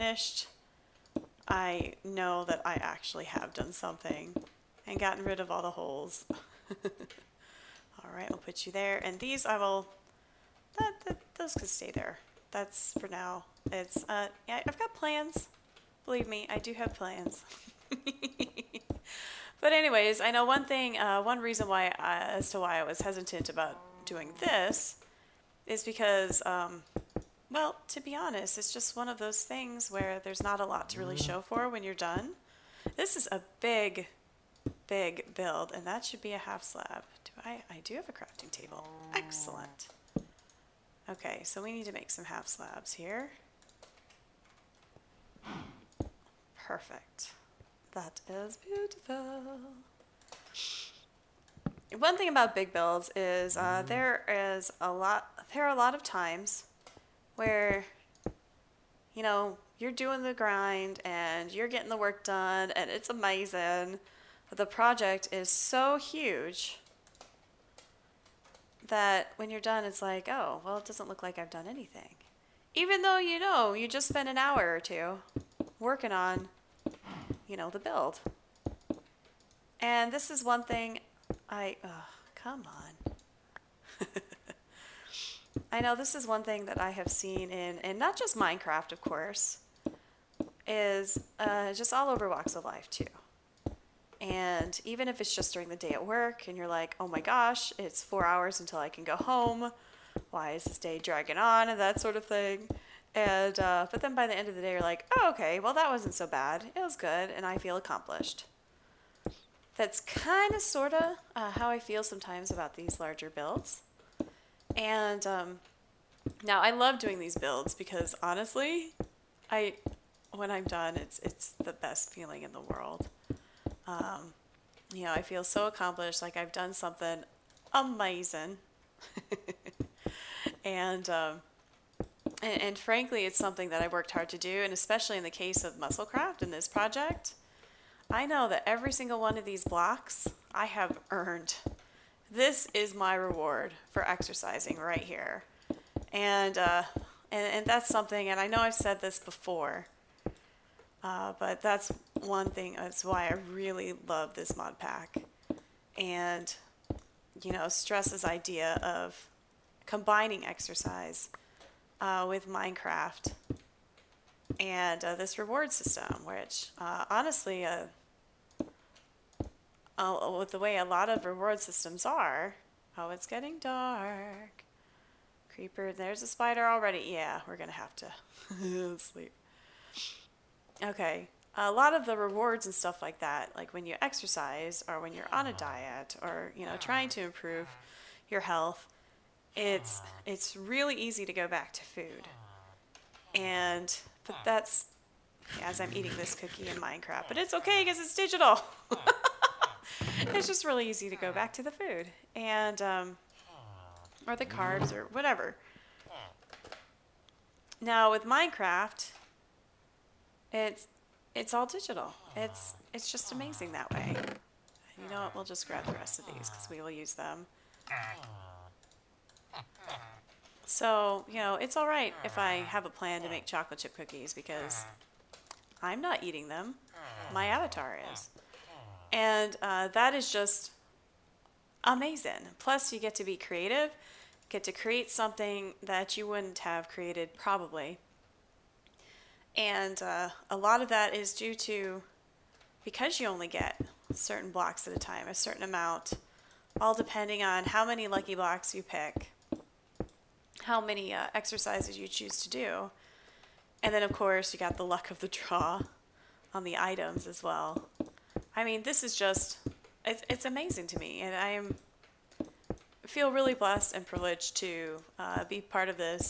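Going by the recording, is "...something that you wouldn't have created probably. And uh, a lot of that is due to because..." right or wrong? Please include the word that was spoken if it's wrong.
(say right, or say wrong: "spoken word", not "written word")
right.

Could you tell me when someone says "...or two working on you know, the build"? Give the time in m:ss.
1:14.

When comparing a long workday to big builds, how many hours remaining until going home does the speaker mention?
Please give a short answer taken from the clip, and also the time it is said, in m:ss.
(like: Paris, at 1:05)
4, at 1:38.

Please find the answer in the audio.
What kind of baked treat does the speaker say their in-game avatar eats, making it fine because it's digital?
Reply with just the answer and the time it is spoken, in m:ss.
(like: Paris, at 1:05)
cookie, at 3:16.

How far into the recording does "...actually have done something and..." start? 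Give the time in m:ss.
0:02.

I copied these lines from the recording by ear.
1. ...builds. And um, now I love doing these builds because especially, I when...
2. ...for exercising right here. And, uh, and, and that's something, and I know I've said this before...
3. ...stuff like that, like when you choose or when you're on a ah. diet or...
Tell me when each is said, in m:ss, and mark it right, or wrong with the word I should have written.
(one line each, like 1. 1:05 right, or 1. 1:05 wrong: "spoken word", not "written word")
1. 1:53 wrong: "honestly", not "especially"
2. 2:23 right
3. 3:02 wrong: "exercise", not "choose".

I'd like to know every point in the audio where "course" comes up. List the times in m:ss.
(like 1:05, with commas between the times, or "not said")
1:29, 4:14.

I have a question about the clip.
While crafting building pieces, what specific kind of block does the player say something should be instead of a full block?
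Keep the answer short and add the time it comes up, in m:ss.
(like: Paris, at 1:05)
half slab, at 0:36.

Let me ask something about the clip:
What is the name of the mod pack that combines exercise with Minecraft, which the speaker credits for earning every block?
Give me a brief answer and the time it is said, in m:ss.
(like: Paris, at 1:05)
Musclecraft, at 2:15.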